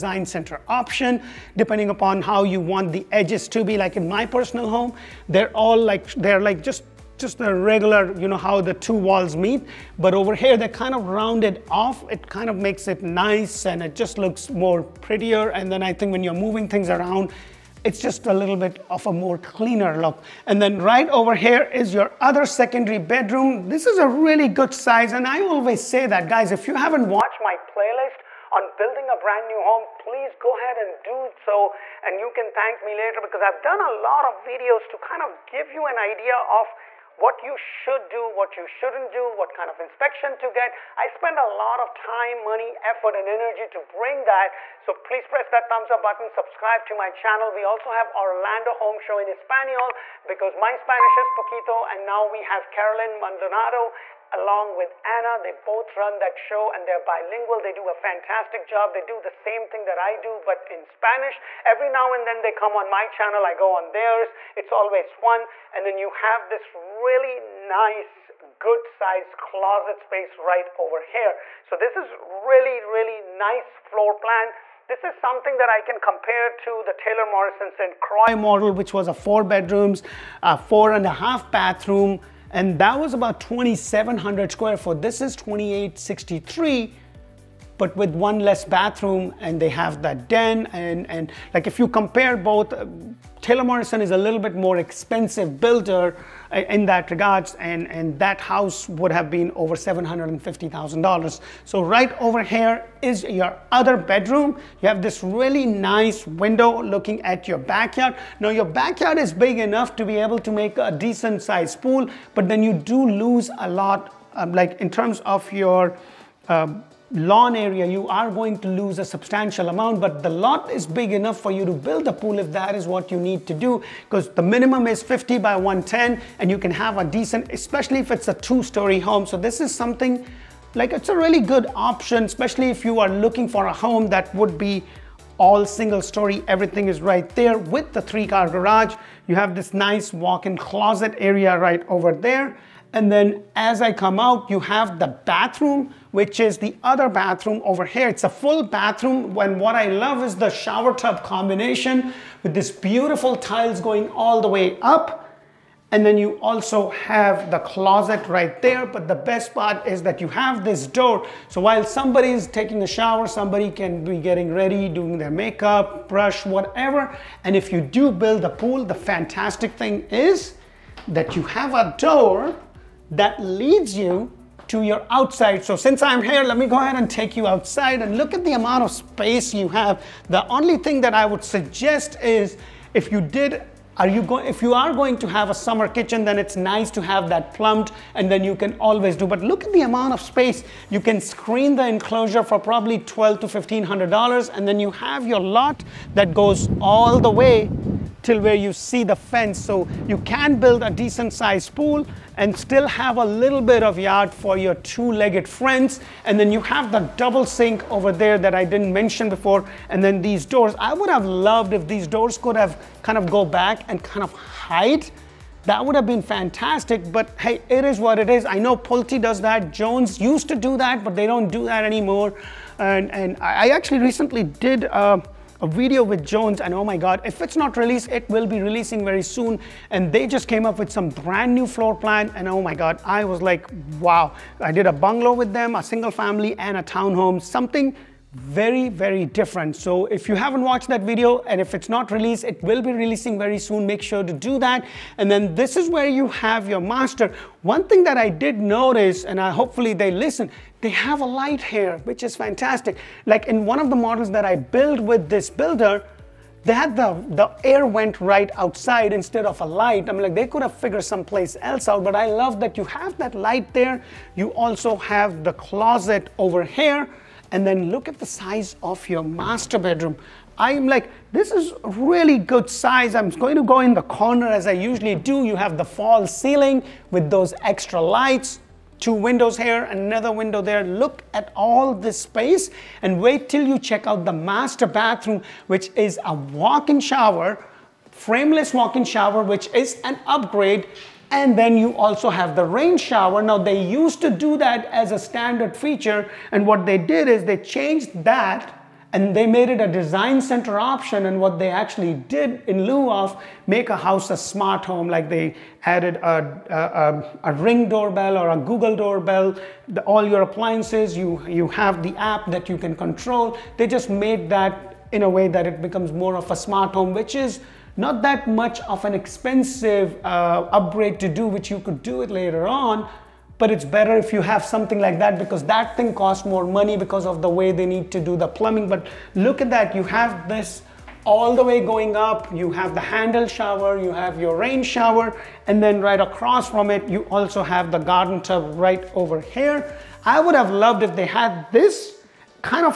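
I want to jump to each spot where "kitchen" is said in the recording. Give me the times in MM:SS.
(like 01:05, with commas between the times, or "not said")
03:05.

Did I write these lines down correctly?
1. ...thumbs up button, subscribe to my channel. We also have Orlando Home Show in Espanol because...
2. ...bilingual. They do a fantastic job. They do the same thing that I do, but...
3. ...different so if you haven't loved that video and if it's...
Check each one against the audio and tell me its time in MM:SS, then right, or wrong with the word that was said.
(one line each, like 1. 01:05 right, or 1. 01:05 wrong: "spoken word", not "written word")
1. 00:45 right
2. 00:56 right
3. 03:59 wrong: "watched", not "loved".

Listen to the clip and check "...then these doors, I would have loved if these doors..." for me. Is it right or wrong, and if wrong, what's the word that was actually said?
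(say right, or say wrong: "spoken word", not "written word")
right.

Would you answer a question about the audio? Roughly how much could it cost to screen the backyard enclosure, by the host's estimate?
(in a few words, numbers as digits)
$1,200 to $1,500.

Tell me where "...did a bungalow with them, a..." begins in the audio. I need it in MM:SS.
03:54.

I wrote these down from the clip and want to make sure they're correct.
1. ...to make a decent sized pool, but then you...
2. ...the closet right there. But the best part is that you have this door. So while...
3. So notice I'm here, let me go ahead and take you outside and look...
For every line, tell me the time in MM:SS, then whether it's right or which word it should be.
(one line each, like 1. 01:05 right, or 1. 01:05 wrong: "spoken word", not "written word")
1. 01:50 right
2. 02:37 right
3. 02:55 wrong: "since", not "notice".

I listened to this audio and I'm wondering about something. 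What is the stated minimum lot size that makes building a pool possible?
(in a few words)
50 by 110.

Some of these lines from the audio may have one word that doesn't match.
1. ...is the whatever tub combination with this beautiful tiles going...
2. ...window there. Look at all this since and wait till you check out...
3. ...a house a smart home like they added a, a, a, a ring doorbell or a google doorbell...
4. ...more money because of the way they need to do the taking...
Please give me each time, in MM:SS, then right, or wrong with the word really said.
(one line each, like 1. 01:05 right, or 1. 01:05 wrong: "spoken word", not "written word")
1. 02:30 wrong: "shower", not "whatever"
2. 04:40 wrong: "space", not "since"
3. 05:03 right
4. 05:26 wrong: "plumbing", not "taking".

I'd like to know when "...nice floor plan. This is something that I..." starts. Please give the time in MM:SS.
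01:13.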